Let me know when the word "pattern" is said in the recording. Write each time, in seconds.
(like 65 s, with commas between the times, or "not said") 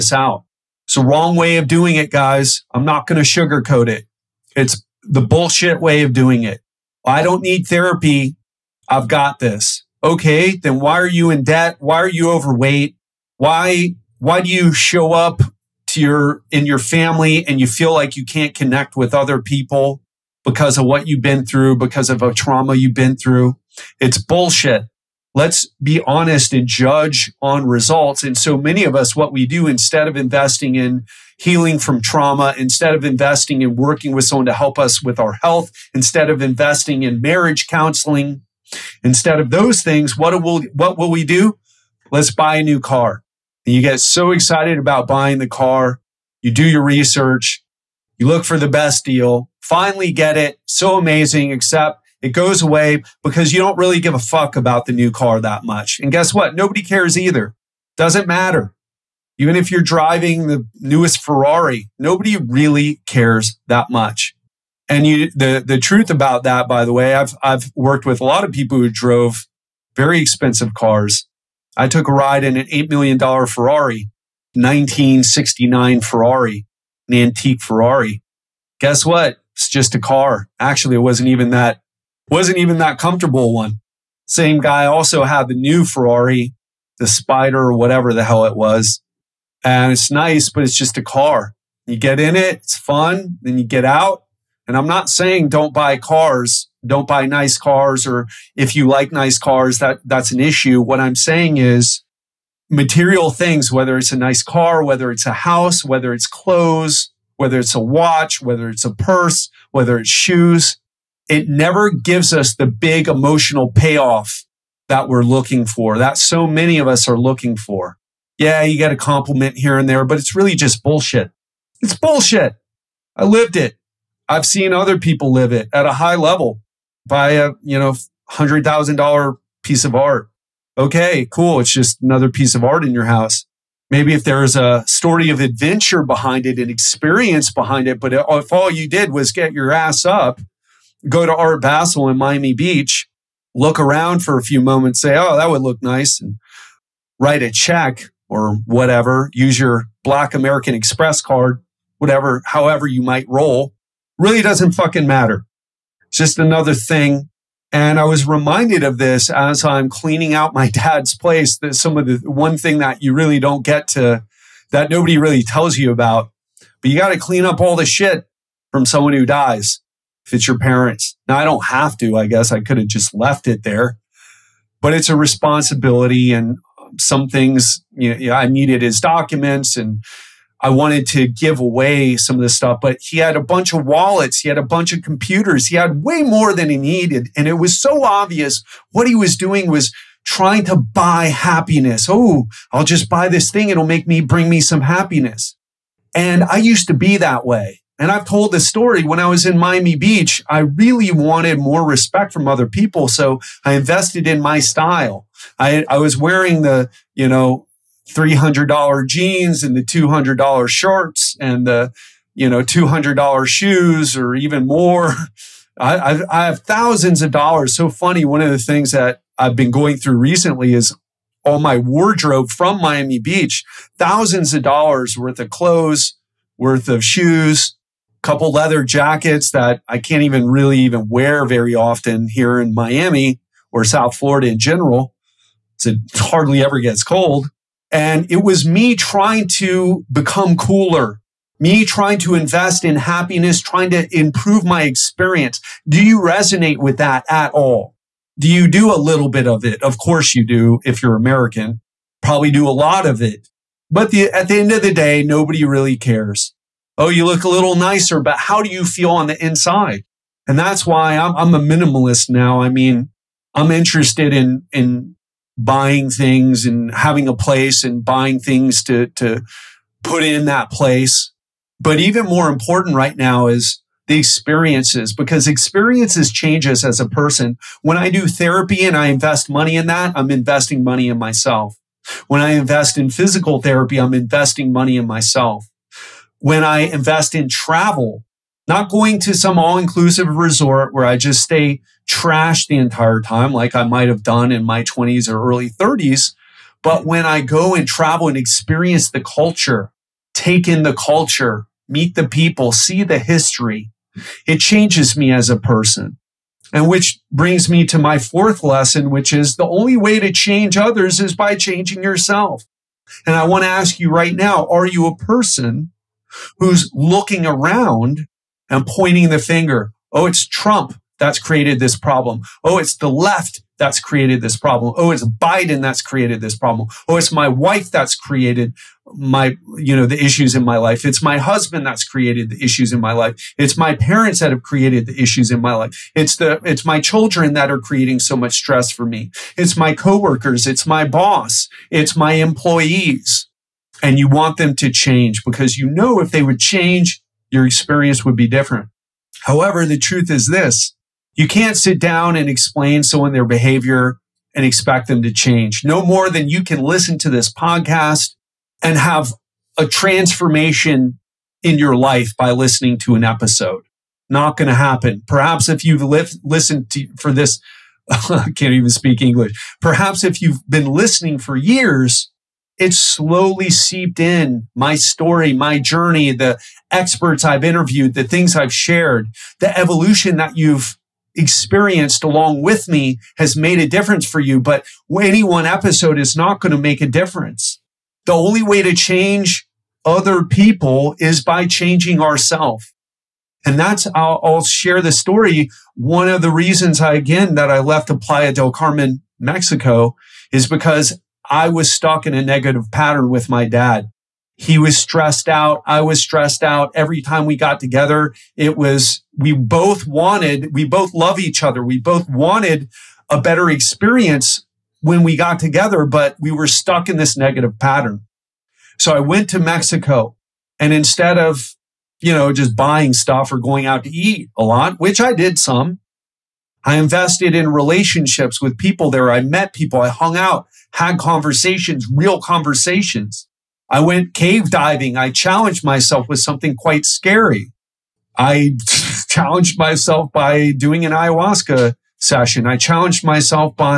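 402 s, 417 s.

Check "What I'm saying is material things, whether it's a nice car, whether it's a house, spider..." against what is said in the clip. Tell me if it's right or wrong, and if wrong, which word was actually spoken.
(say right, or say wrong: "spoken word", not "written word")
wrong: "whether", not "spider".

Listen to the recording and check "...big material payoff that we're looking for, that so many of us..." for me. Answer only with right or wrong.
wrong.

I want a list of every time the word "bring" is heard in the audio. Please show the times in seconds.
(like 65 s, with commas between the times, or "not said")
194 s, 307 s.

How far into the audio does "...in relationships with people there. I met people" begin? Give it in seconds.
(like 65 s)
427 s.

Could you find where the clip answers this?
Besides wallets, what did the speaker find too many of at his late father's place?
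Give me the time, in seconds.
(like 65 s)
185 s.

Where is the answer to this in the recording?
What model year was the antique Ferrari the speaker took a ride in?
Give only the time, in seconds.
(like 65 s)
74 s.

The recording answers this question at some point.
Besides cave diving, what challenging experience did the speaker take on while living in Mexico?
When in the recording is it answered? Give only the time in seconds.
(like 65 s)
441 s.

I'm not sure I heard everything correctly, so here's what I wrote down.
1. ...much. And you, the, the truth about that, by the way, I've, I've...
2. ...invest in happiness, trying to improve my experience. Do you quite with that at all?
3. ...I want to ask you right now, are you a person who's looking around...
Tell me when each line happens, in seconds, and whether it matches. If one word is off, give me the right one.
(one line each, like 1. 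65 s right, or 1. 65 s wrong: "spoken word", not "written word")
1. 63 s right
2. 242 s wrong: "resonate", not "quite"
3. 313 s right.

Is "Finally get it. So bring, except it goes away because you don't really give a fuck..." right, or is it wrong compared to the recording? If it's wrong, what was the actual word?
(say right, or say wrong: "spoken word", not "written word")
wrong: "amazing", not "bring".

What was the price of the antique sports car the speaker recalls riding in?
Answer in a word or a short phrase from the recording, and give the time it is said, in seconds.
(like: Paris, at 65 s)
$8 million, at 72 s.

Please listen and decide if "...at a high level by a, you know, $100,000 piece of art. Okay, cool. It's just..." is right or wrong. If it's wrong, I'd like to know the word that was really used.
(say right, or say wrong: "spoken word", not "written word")
right.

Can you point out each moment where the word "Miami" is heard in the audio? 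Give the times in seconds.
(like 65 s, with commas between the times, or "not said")
142 s, 199 s, 222 s, 232 s.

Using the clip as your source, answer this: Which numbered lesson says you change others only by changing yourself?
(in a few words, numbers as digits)
4.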